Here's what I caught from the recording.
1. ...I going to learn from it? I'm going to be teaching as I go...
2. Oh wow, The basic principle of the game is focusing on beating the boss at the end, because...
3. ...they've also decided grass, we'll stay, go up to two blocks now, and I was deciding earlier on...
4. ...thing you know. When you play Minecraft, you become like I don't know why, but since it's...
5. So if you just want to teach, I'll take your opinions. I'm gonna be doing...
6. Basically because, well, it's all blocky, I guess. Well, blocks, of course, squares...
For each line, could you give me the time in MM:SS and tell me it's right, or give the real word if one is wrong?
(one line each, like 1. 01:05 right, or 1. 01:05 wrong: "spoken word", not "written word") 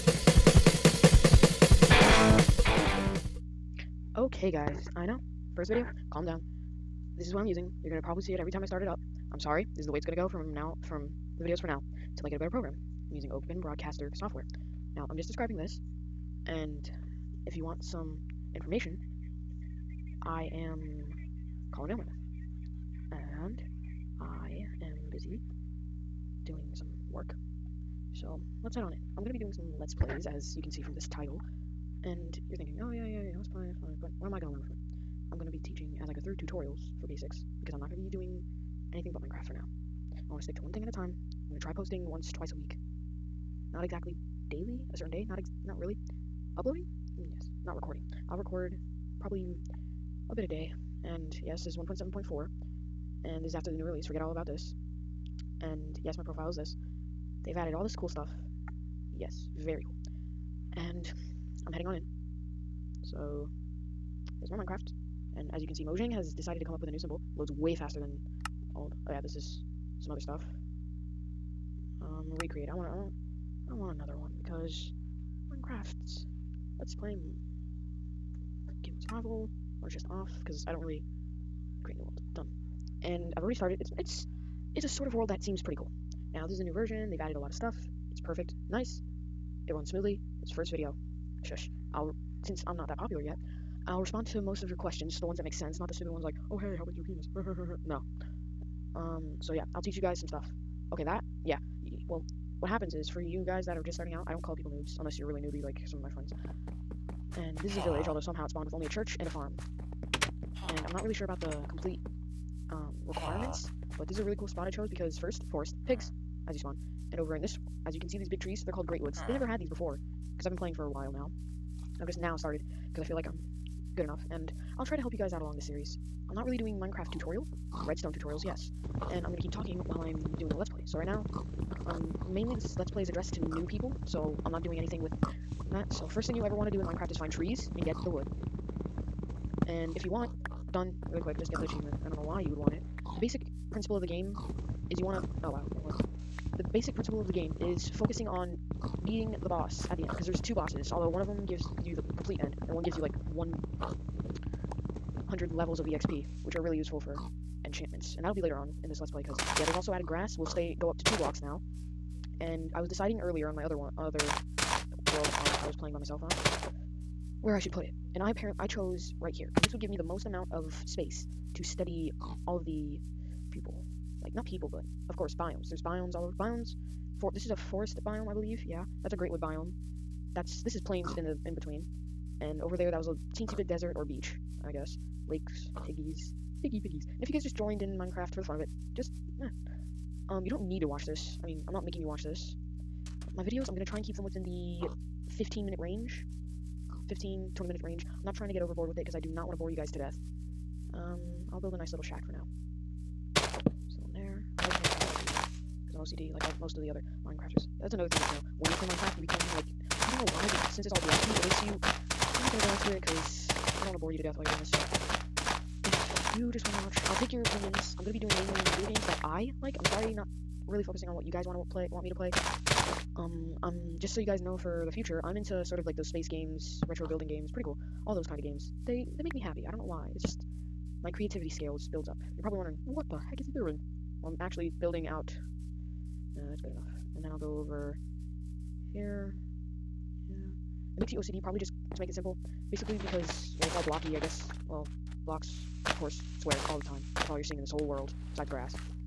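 1. 00:34 right
2. 02:25 right
3. 02:39 wrong: "added", not "decided"
4. 03:28 right
5. 03:34 wrong: "watch", not "teach"
6. 04:02 right.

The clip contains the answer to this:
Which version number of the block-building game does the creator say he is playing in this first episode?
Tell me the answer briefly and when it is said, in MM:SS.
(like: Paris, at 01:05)
1.7.4, at 00:51.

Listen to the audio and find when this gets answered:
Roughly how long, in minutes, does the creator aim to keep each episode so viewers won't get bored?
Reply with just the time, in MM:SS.
03:17.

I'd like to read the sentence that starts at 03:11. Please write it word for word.
I mean, I'm not making you watch this.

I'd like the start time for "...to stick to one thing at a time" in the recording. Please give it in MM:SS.
00:40.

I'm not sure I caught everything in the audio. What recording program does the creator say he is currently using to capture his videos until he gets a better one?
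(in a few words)
Open Broadcaster Software.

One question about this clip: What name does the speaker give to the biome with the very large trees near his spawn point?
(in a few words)
Great Woods.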